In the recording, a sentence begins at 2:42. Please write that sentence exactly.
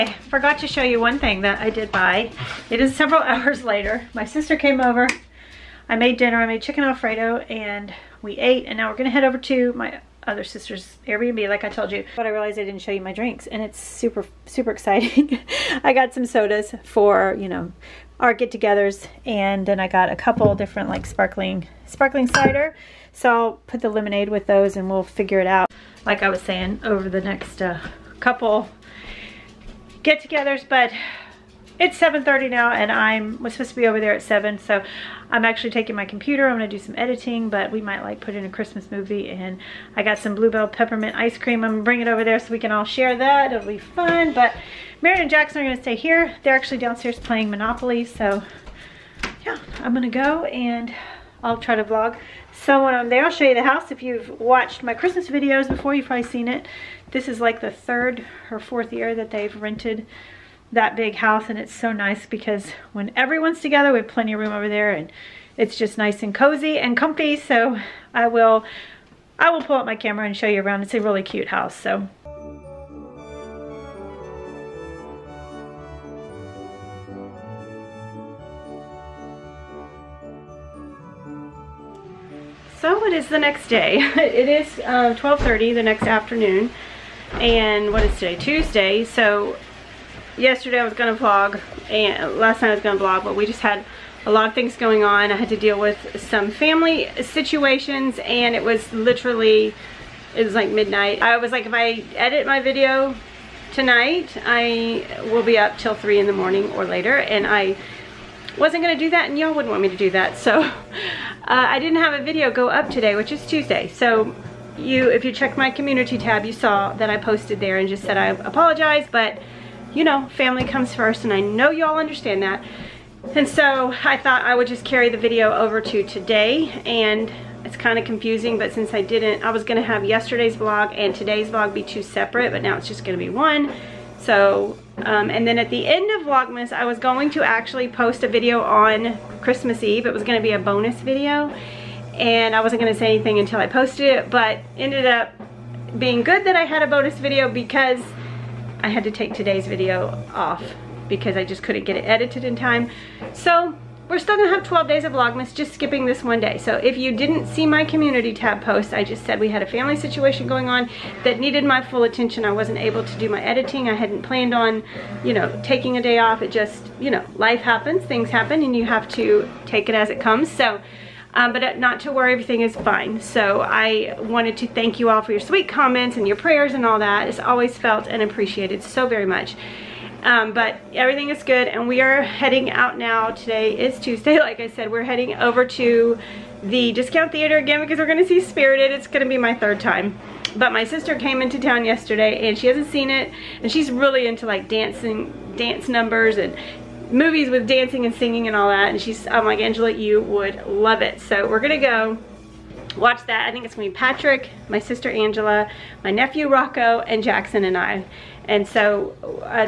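I wasn't able to do my editing.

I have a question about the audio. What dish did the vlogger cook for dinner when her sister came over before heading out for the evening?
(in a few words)
Chicken alfredo.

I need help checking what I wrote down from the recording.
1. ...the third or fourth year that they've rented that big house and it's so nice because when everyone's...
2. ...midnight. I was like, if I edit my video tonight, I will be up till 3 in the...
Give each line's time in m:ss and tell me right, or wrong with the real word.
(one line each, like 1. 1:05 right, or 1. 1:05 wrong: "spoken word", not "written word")
1. 0:57 right
2. 1:40 right.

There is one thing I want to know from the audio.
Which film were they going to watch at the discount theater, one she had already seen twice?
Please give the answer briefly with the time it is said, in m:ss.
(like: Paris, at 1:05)
Spirited, at 3:08.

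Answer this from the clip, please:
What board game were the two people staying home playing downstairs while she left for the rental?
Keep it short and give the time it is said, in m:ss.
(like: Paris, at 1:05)
Monopoly, at 0:47.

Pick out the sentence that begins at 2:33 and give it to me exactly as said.
So we're still gonna have 12 days of Vlogmas, just skipping this one day.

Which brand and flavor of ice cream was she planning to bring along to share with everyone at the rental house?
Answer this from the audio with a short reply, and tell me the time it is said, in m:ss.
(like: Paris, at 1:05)
Blue Bell Peppermint, at 0:40.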